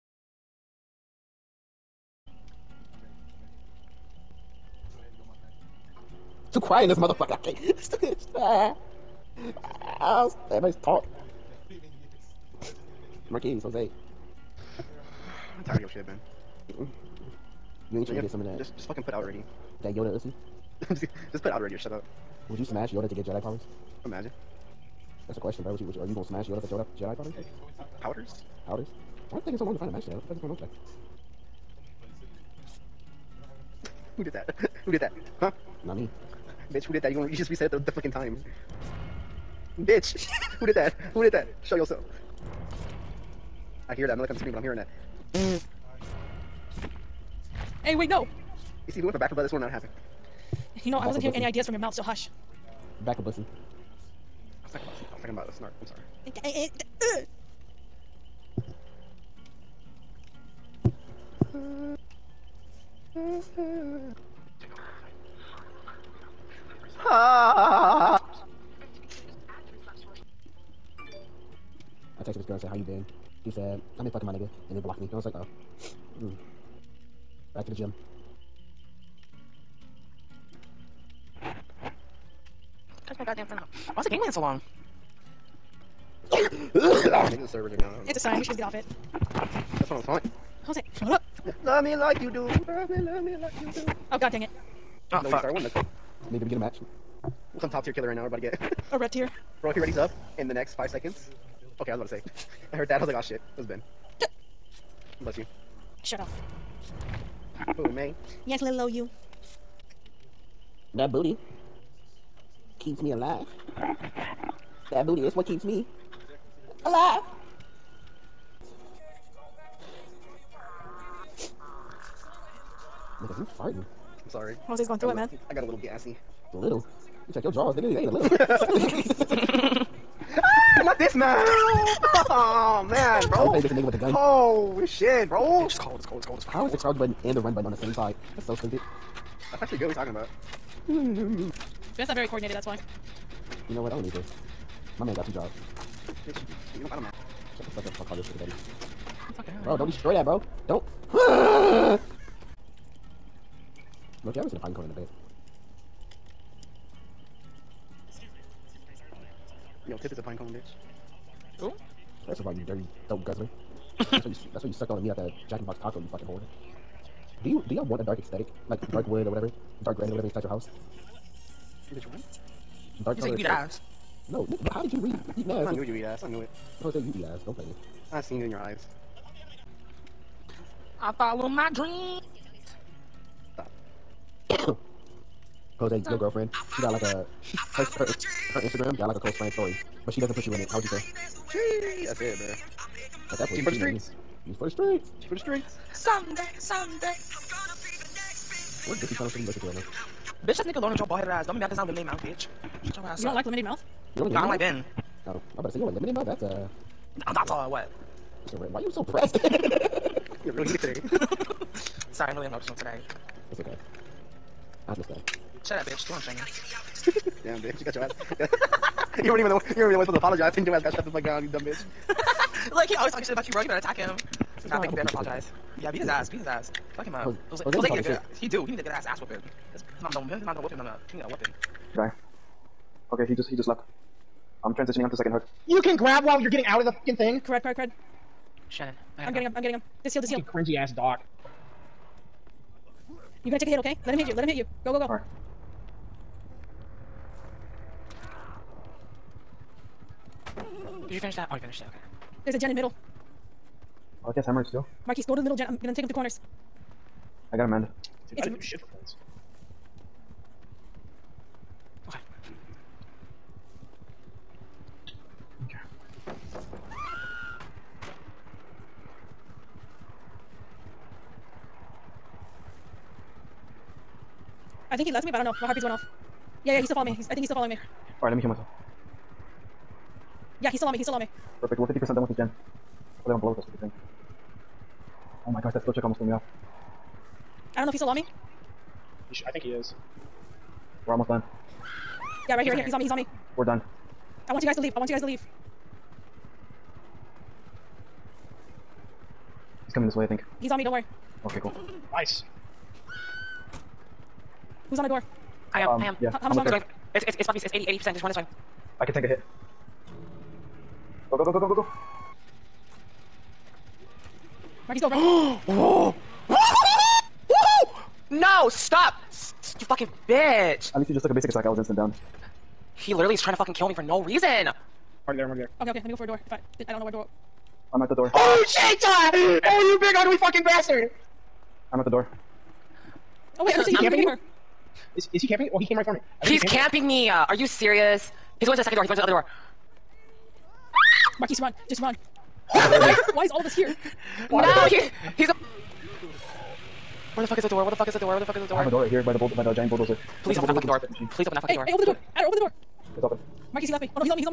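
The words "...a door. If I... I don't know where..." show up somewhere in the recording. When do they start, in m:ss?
5:26.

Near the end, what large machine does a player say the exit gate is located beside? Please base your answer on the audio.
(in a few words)
Giant bulldozer.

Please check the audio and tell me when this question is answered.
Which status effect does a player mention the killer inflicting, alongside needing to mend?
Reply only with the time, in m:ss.
4:14.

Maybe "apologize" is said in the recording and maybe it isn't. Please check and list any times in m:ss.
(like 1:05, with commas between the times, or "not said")
3:40, 3:45.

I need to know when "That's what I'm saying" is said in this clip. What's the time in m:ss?
1:29.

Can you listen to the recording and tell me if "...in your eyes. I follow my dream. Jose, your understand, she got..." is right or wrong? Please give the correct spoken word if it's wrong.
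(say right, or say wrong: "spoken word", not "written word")
wrong: "girlfriend", not "understand".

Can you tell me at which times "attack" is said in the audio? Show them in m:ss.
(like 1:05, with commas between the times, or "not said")
3:43, 5:21.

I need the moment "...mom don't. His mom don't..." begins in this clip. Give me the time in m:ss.
3:50.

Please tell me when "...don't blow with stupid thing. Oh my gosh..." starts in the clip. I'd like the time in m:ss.
4:43.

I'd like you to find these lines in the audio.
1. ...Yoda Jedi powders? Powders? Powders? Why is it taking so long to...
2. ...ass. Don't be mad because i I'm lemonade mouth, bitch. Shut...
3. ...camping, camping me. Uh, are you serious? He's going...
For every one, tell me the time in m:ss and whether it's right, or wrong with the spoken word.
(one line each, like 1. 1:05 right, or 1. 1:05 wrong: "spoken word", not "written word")
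1. 0:26 right
2. 3:21 right
3. 5:36 right.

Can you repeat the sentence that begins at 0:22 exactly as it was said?
Would you smash Yoda to get Jedi powers?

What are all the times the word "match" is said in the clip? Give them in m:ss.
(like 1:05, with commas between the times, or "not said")
0:29, 1:36.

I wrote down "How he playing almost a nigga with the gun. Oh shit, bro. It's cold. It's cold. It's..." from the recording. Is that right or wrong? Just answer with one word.
wrong.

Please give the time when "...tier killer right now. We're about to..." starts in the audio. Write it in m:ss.
1:37.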